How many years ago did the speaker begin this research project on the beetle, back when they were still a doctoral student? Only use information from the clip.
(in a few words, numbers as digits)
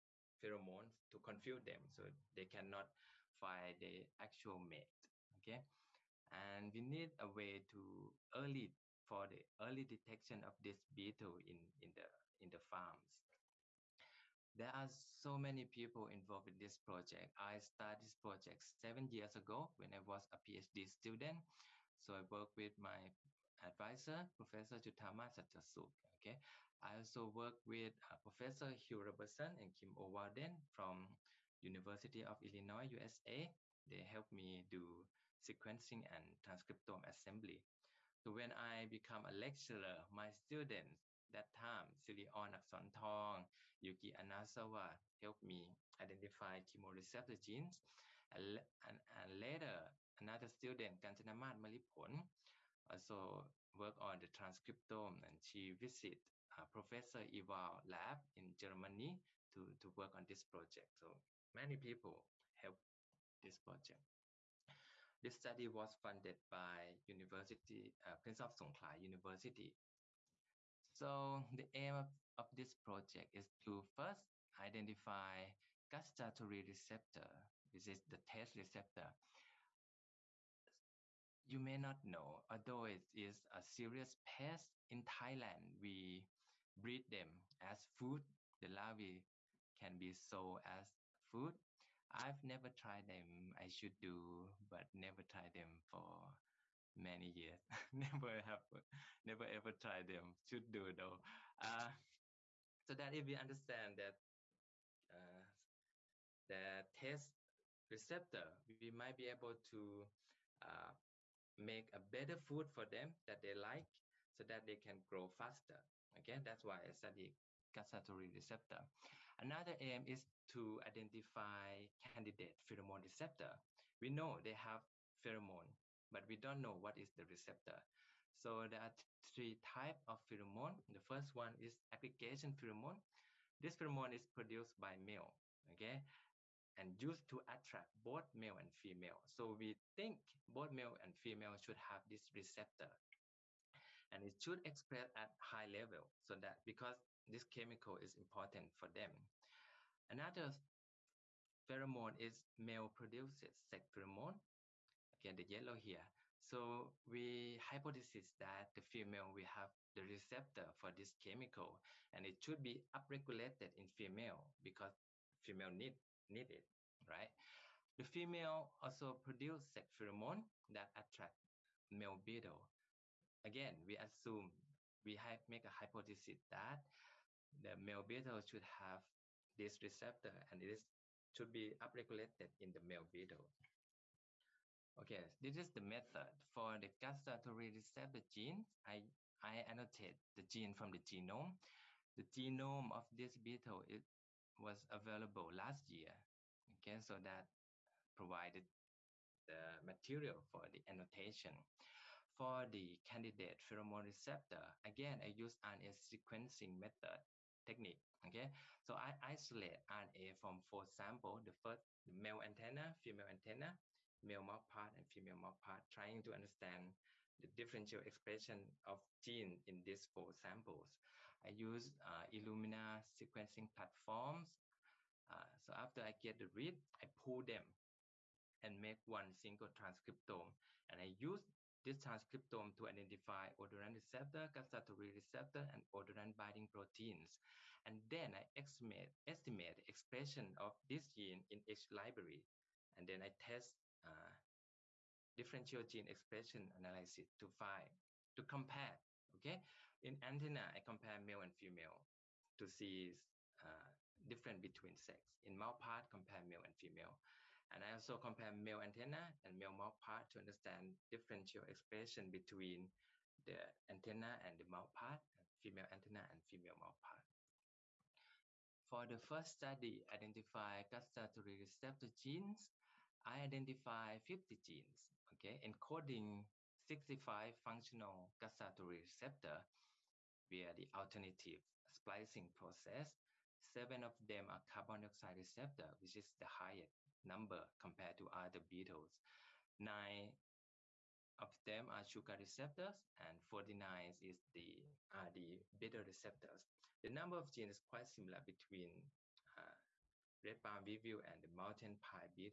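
7.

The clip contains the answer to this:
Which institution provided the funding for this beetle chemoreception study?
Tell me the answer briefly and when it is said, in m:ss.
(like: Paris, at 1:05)
Prince of Songkhla University, at 1:08.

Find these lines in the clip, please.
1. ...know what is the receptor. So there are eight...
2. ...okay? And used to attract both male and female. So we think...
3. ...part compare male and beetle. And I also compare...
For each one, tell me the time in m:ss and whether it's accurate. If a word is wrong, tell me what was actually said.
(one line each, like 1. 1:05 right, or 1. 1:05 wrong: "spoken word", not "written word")
1. 2:06 wrong: "three", not "eight"
2. 2:15 right
3. 4:15 wrong: "female", not "beetle".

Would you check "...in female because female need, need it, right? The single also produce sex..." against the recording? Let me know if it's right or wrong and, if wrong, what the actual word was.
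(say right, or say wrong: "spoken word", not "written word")
wrong: "female", not "single".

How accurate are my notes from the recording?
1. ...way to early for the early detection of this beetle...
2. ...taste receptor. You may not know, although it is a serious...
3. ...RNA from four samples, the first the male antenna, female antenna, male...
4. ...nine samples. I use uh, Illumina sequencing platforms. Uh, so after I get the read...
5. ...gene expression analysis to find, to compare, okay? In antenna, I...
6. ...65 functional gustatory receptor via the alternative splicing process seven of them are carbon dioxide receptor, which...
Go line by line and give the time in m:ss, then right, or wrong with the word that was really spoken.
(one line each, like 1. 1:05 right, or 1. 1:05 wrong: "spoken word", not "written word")
1. 0:07 right
2. 1:18 right
3. 3:29 right
4. 3:40 wrong: "four", not "nine"
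5. 4:05 right
6. 4:36 right.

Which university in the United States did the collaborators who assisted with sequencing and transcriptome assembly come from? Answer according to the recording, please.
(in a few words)
University of Illinois.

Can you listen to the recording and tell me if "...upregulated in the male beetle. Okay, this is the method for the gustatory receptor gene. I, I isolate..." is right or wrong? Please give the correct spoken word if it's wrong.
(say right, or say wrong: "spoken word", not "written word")
wrong: "annotate", not "isolate".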